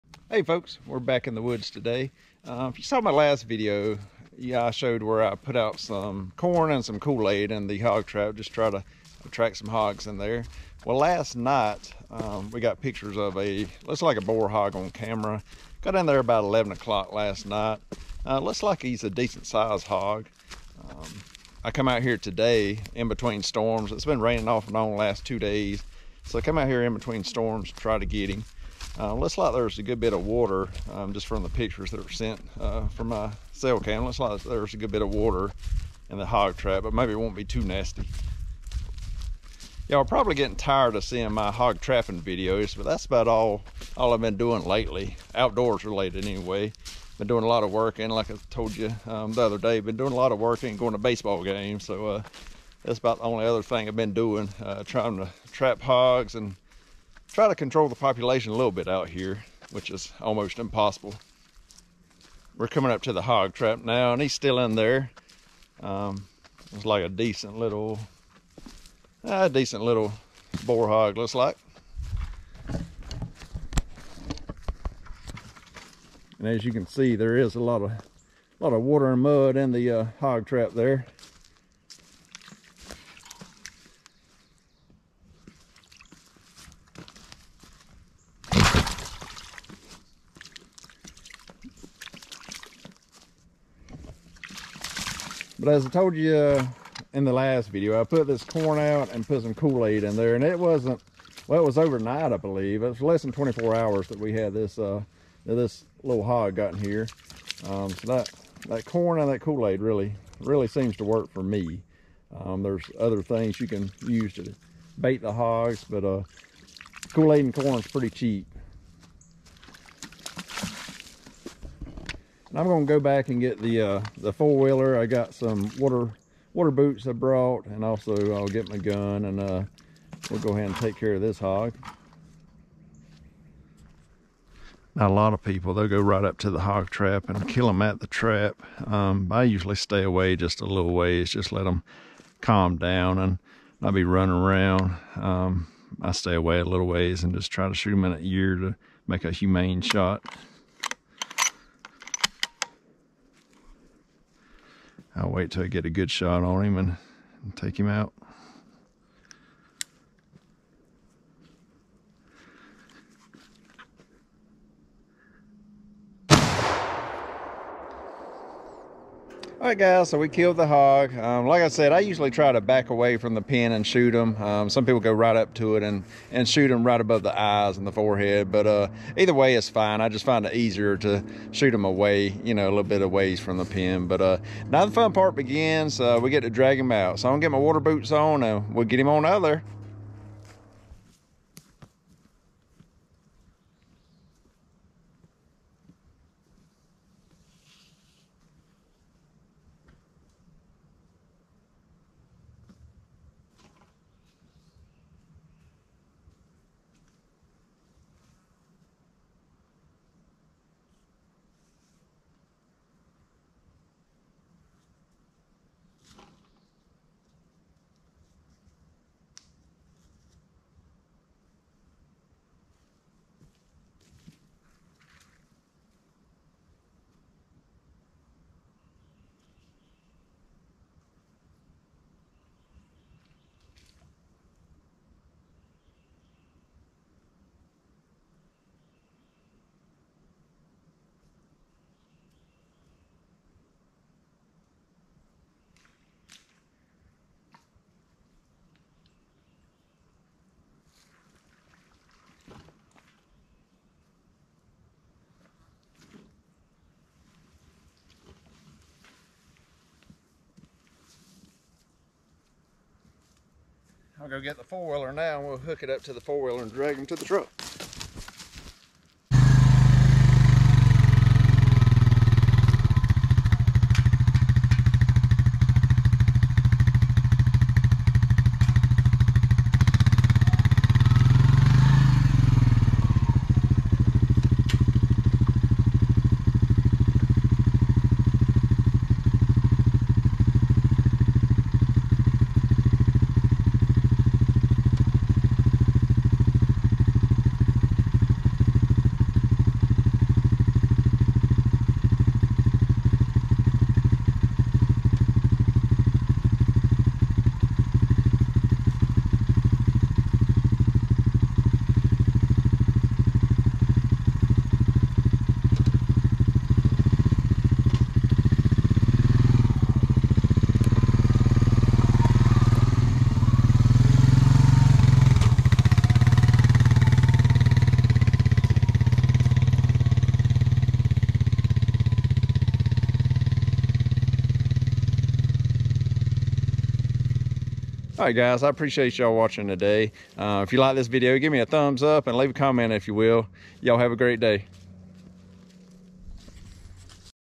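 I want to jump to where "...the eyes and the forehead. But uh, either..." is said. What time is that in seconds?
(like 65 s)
177 s.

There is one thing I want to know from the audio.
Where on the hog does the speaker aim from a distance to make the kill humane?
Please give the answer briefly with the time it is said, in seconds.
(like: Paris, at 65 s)
In an ear, at 148 s.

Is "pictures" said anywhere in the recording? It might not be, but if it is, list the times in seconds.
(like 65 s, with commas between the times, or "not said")
12 s, 31 s.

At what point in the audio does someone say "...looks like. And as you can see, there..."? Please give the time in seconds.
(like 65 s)
71 s.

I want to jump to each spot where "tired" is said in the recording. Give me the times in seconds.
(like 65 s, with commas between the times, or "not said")
40 s.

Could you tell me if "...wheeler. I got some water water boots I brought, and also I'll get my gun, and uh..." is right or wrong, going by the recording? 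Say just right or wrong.
right.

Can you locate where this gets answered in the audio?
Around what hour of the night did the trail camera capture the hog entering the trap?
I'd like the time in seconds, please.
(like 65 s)
16 s.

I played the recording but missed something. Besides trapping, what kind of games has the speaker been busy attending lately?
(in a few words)
Baseball games.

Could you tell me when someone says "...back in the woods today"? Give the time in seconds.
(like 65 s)
1 s.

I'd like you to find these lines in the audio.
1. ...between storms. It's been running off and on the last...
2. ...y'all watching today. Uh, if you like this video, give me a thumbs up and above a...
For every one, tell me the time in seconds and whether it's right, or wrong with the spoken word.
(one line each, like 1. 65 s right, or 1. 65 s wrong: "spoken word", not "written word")
1. 23 s wrong: "raining", not "running"
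2. 339 s wrong: "leave", not "above".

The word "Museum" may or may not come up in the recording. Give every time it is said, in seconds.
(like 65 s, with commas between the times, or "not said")
not said.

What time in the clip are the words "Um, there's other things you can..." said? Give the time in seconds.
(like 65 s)
112 s.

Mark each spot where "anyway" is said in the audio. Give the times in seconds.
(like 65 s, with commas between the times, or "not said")
46 s.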